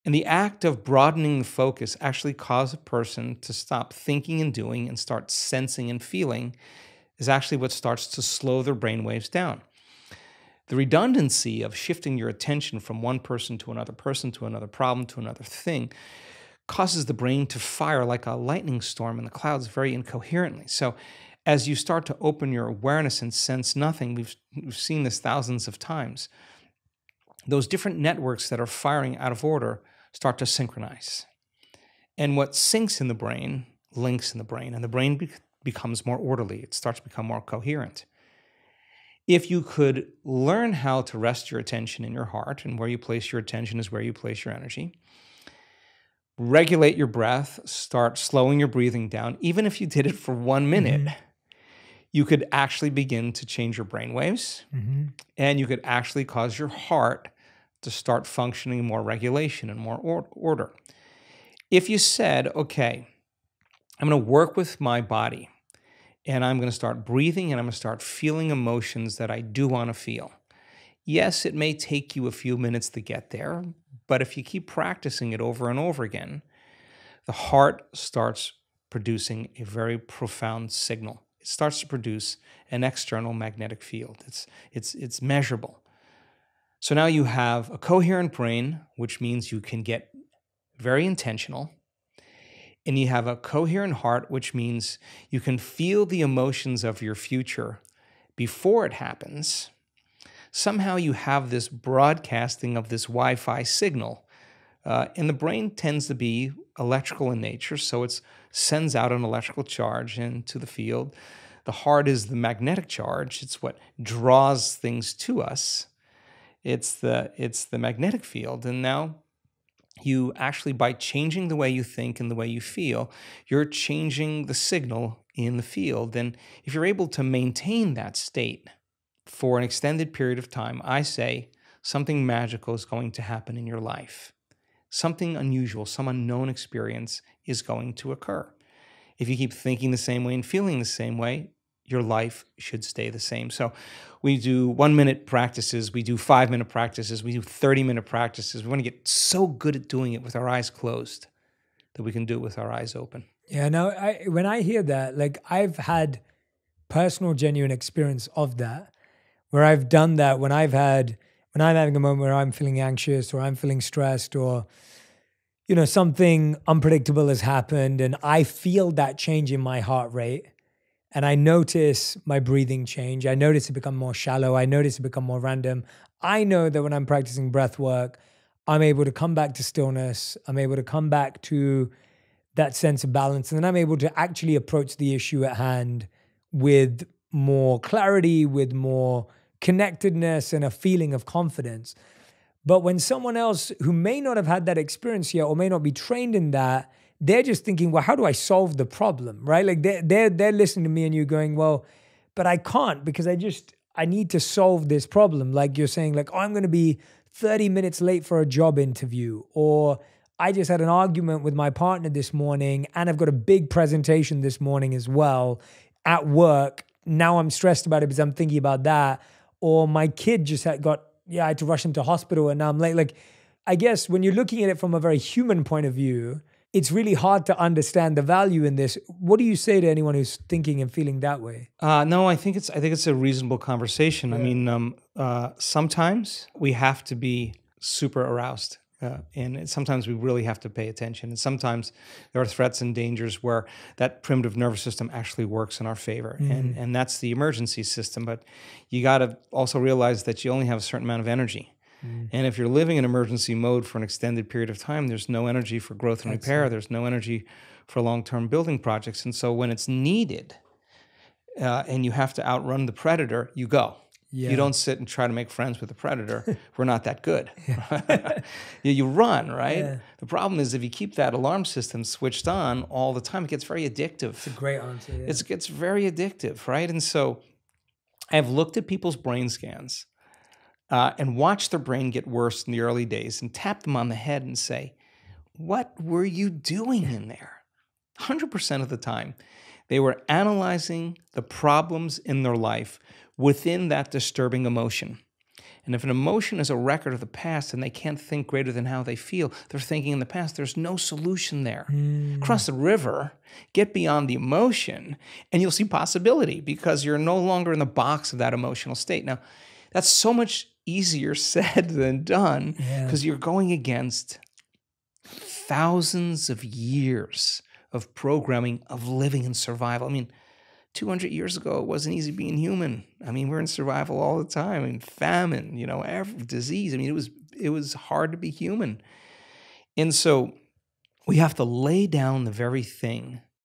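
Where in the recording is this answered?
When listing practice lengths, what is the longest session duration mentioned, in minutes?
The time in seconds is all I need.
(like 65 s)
147 s.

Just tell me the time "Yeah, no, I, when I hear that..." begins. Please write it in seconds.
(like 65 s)
153 s.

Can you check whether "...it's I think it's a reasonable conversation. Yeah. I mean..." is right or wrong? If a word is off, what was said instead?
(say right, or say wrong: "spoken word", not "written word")
right.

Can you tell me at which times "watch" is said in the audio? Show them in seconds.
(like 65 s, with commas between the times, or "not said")
281 s.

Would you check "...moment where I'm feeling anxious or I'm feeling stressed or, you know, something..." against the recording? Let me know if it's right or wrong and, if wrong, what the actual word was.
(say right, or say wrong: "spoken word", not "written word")
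right.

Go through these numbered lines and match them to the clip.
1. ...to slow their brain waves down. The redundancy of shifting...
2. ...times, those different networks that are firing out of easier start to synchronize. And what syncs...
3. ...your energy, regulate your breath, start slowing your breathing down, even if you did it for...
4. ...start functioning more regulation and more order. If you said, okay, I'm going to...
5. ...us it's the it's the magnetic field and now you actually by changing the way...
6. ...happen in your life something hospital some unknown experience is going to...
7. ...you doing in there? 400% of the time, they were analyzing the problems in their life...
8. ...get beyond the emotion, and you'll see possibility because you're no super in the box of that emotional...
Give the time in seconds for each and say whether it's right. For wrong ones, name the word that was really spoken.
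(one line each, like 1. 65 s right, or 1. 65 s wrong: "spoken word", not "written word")
1. 8 s right
2. 25 s wrong: "order", not "easier"
3. 44 s right
4. 57 s right
5. 115 s right
6. 133 s wrong: "unusual", not "hospital"
7. 286 s wrong: "100", not "400"
8. 303 s wrong: "longer", not "super".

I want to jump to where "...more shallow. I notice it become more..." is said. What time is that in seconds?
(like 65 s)
173 s.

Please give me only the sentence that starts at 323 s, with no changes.
I mean, we're in survival all the time, I mean, famine, you know, every, disease.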